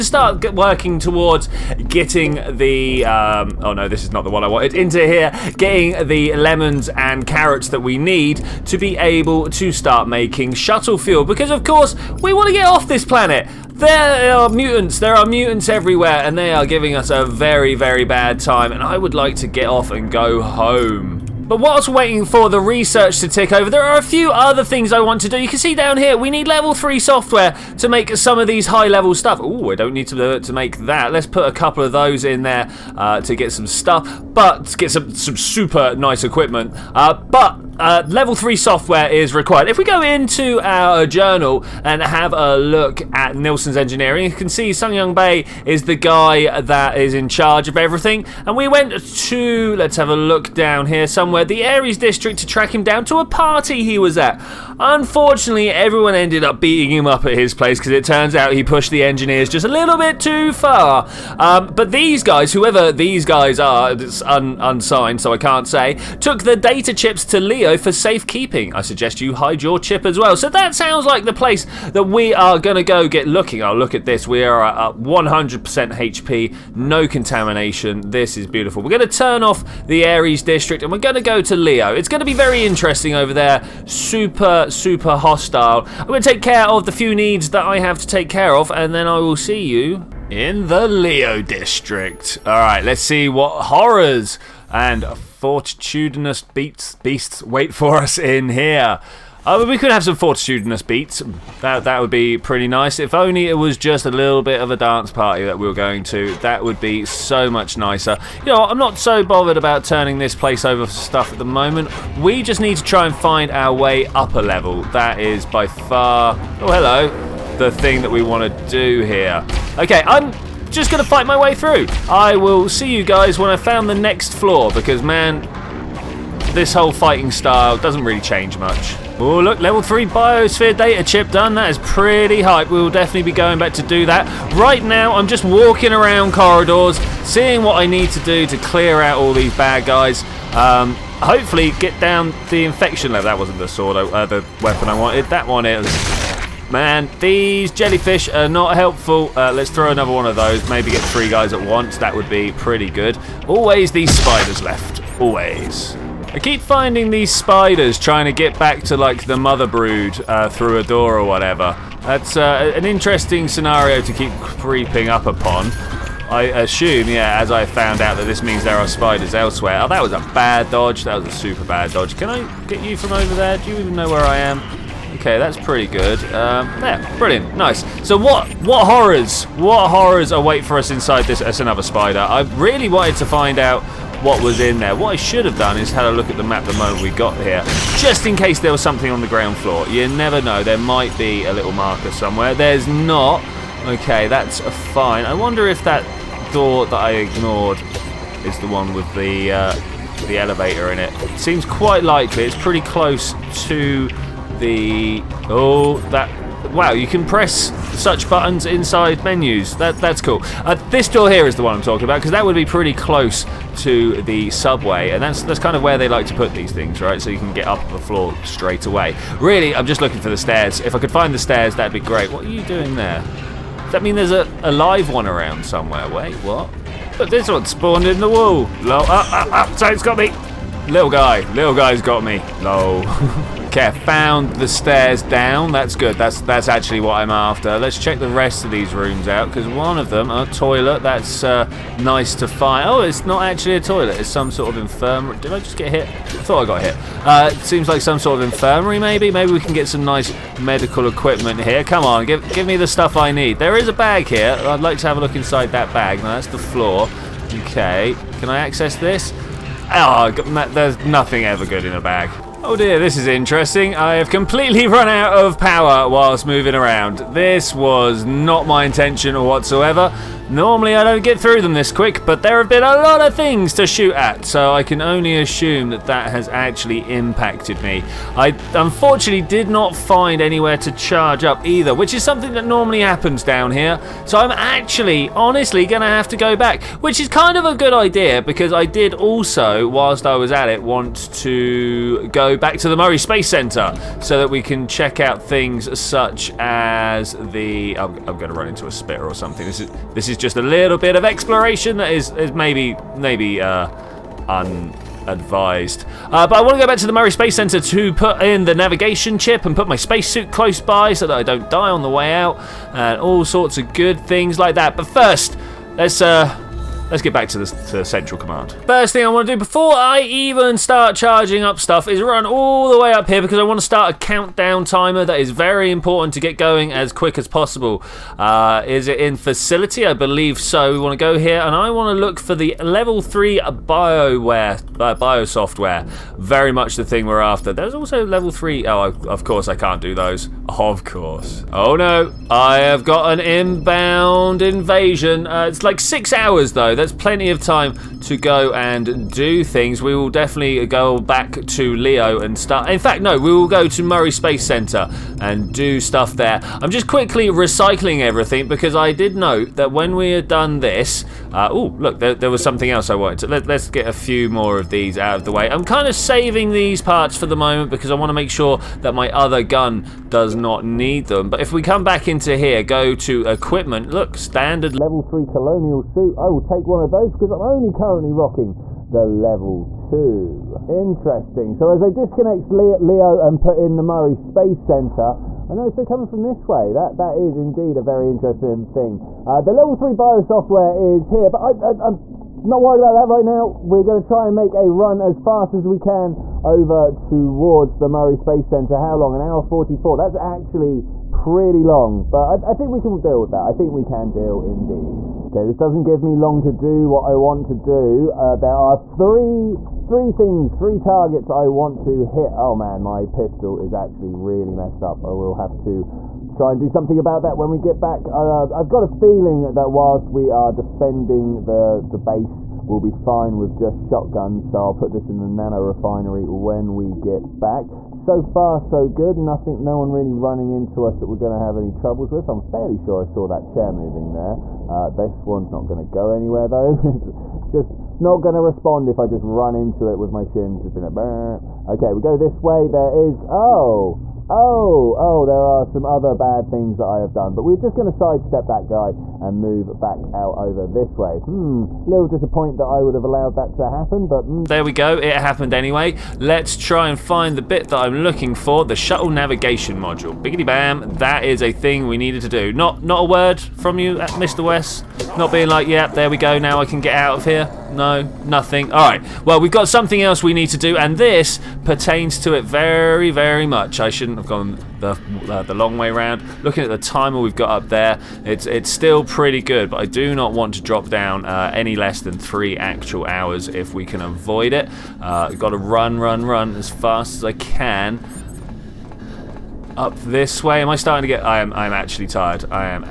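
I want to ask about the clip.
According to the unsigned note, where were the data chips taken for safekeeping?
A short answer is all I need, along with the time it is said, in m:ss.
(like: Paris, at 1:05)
Leo video, at 1:07.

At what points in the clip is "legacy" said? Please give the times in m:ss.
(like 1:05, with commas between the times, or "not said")
not said.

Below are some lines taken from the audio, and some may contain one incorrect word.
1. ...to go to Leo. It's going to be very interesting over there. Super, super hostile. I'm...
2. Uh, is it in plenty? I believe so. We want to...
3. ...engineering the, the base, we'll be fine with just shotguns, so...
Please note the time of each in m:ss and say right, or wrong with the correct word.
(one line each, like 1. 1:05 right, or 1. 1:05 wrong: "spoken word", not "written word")
1. 1:21 right
2. 5:28 wrong: "facility", not "plenty"
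3. 7:00 wrong: "defending", not "engineering".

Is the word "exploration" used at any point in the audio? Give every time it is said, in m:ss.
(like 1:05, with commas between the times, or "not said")
5:01.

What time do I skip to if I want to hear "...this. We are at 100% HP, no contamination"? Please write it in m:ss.
1:14.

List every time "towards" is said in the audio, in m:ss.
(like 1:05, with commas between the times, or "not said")
0:00, 6:37.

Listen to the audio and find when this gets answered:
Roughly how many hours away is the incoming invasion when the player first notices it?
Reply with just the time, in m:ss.
5:45.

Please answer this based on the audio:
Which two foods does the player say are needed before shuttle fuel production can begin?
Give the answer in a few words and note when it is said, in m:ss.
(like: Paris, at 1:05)
lemons and carrots, at 0:06.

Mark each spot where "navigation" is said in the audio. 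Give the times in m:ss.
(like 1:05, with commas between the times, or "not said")
5:08, 7:39.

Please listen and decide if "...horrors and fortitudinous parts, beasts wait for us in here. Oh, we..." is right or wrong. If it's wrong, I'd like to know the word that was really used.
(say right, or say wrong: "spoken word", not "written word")
wrong: "beats", not "parts".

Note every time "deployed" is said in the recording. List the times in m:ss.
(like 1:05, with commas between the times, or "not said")
not said.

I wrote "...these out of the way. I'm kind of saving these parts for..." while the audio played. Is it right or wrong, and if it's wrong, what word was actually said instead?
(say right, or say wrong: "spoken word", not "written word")
right.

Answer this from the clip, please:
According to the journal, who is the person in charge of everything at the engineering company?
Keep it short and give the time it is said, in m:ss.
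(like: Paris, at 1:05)
Sung Young Bay, at 0:44.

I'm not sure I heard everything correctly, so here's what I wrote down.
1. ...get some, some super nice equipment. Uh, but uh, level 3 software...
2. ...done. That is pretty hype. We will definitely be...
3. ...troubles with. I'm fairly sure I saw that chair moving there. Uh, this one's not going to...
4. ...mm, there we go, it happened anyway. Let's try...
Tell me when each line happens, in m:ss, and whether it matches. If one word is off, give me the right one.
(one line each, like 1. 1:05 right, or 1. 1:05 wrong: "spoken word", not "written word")
1. 0:34 right
2. 2:11 right
3. 7:11 right
4. 7:34 right.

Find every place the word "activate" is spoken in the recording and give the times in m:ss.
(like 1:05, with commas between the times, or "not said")
not said.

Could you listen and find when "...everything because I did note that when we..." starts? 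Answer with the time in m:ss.
5:58.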